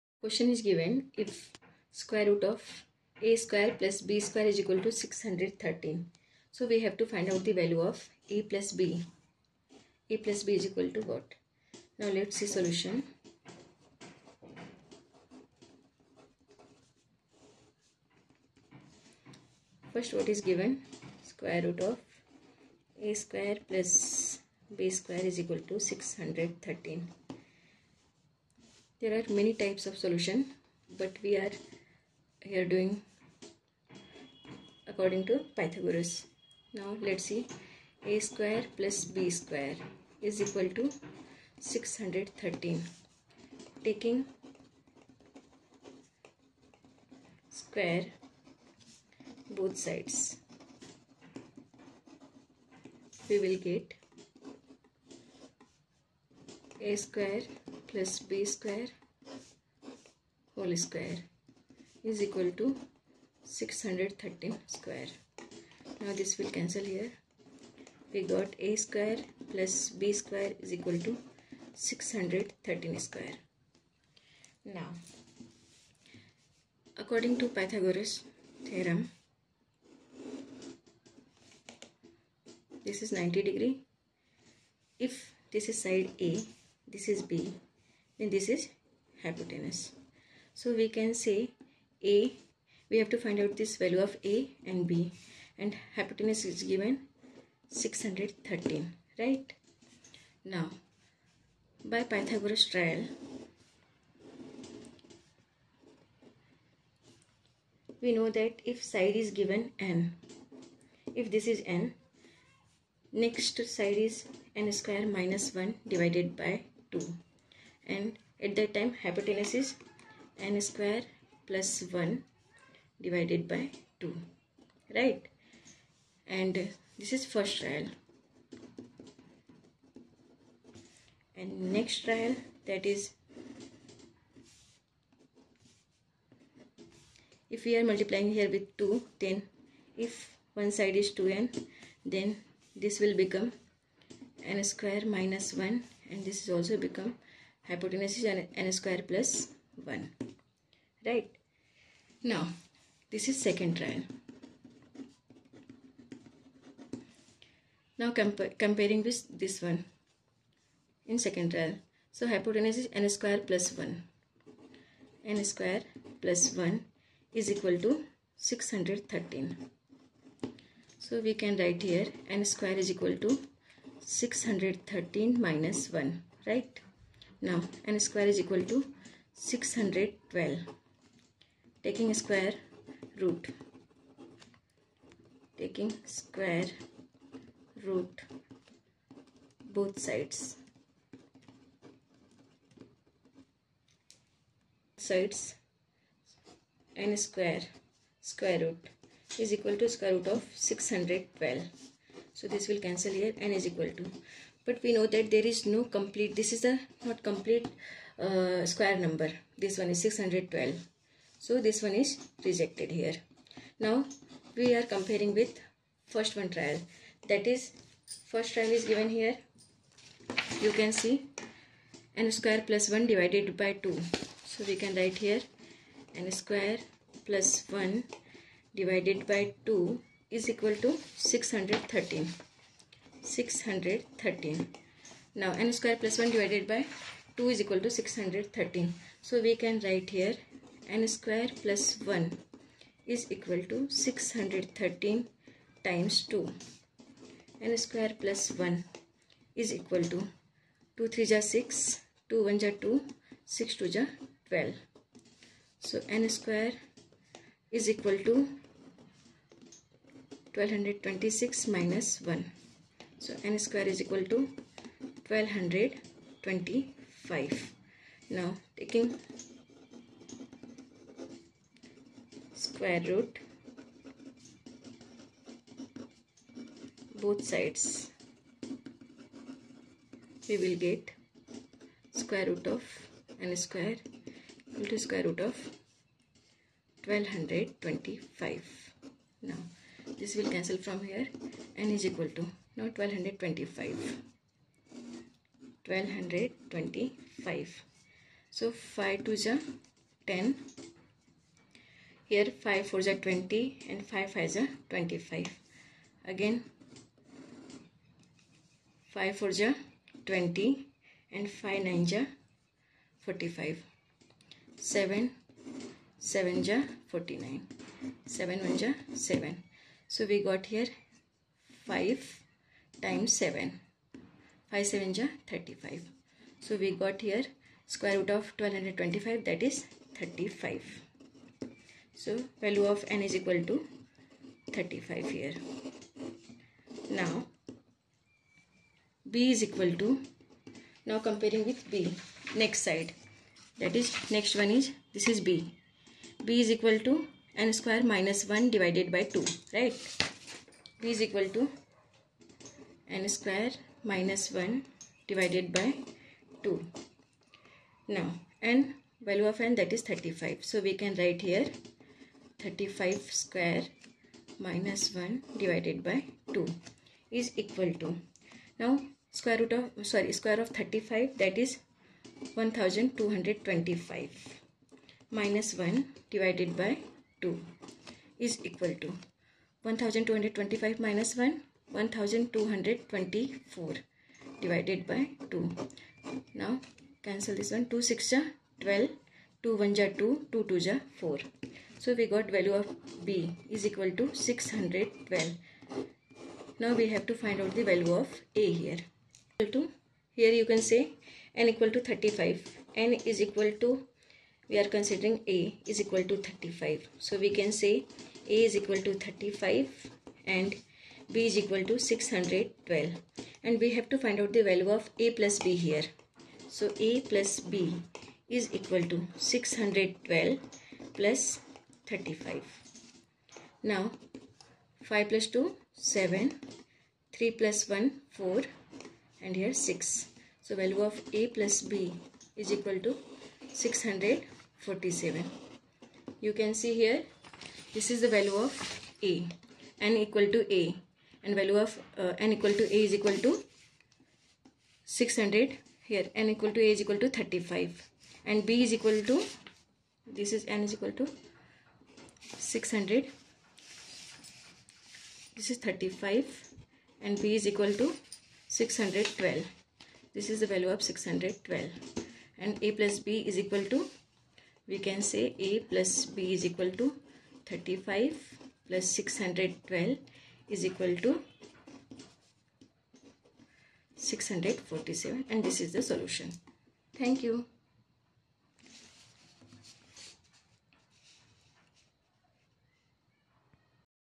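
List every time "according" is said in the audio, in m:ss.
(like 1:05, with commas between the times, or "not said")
0:34, 1:16.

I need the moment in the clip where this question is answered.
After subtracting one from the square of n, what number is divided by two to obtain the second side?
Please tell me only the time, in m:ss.
6:21.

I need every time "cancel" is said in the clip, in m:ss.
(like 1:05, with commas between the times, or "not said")
1:06, 3:22, 4:50, 6:27.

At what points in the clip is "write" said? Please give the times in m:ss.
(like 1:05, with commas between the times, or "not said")
2:51, 3:44, 3:59, 6:01.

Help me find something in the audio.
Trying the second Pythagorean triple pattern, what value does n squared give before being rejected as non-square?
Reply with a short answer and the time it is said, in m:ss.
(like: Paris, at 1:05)
612, at 2:57.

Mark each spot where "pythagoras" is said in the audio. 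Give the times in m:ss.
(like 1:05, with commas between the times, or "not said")
0:35, 1:17, 1:42.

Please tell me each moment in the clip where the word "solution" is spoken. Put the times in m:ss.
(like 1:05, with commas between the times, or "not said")
0:12, 0:29, 7:56.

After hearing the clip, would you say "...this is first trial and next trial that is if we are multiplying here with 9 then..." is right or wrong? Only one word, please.
wrong.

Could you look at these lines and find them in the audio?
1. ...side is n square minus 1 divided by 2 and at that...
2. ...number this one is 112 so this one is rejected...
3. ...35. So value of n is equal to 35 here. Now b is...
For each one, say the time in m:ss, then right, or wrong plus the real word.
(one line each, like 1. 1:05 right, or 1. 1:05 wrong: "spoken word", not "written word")
1. 1:53 right
2. 3:28 wrong: "612", not "112"
3. 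5:30 right.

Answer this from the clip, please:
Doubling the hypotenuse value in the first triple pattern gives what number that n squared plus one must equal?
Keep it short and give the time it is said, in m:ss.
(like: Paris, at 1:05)
1226, at 4:18.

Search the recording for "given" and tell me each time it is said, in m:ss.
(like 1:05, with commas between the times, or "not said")
0:00, 0:20, 1:36, 1:49, 3:38.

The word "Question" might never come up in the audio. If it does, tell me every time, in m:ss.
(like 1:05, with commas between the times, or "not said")
0:00.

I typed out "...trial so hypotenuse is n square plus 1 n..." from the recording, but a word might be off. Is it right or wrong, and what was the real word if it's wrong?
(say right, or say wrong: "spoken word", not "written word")
right.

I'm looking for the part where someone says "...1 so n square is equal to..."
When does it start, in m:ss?
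4:22.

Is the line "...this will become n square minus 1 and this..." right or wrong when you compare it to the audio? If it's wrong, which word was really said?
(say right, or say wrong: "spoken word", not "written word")
right.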